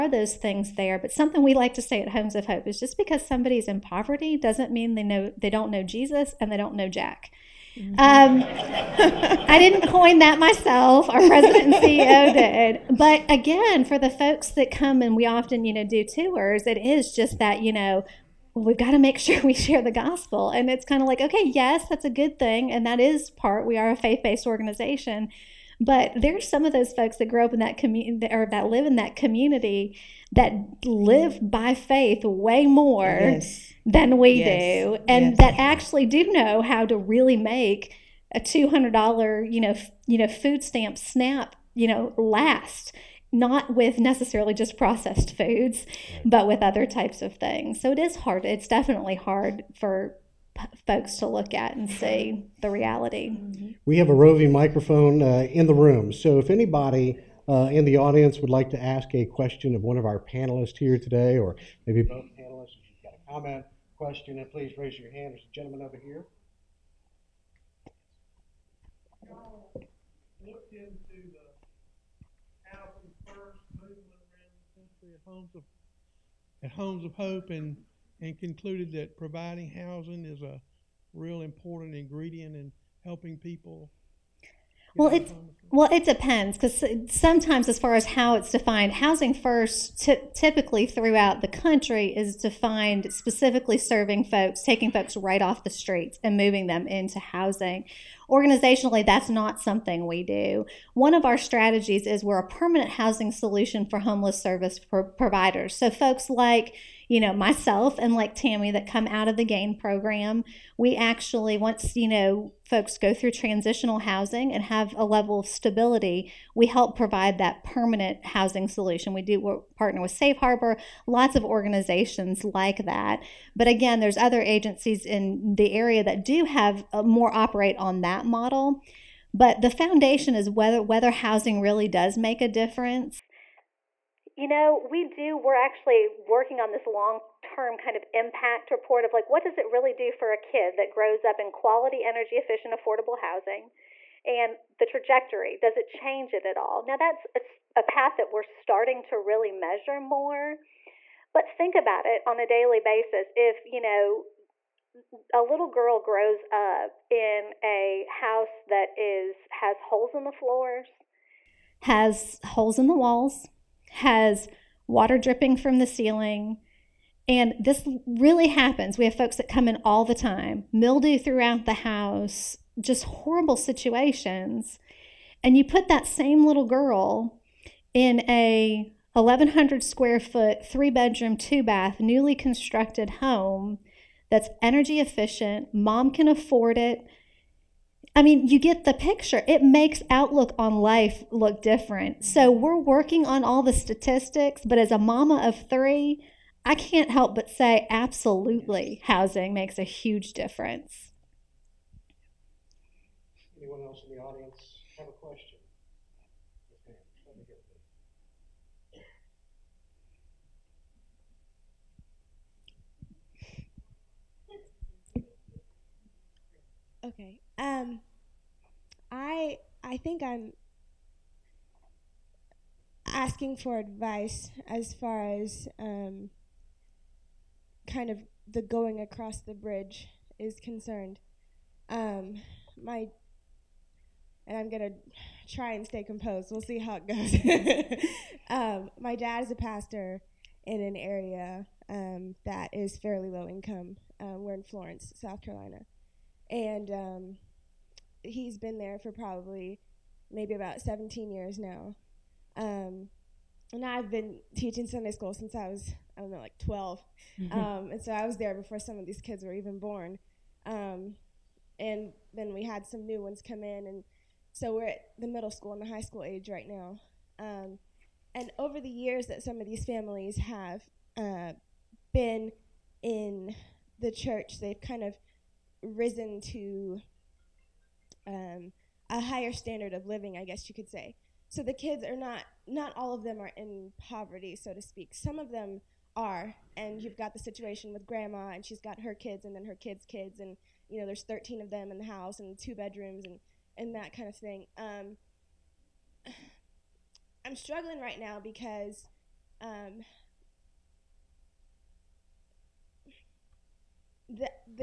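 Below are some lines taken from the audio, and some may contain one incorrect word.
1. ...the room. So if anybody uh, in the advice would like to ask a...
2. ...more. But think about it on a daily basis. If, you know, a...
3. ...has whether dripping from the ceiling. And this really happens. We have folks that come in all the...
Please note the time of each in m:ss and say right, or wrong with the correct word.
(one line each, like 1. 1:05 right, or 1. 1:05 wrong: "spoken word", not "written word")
1. 0:55 wrong: "audience", not "advice"
2. 2:30 right
3. 2:43 wrong: "water", not "whether".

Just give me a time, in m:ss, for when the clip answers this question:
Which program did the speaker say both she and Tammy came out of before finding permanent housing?
1:49.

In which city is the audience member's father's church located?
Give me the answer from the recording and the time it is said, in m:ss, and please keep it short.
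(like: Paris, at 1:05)
Florence, South Carolina, at 4:04.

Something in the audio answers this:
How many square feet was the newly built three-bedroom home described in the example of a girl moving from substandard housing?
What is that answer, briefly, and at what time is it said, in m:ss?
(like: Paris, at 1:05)
1100, at 2:59.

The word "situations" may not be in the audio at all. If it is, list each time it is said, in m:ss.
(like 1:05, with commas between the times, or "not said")
2:53, 4:47.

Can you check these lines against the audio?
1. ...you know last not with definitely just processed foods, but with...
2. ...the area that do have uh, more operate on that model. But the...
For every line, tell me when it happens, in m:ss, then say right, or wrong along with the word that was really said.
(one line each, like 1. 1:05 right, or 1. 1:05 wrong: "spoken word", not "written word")
1. 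0:41 wrong: "necessarily", not "definitely"
2. 2:05 right.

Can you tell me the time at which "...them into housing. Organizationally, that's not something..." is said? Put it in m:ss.
1:36.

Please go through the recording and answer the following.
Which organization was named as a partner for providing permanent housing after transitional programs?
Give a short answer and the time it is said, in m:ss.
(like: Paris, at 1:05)
Safe Harbor, at 2:00.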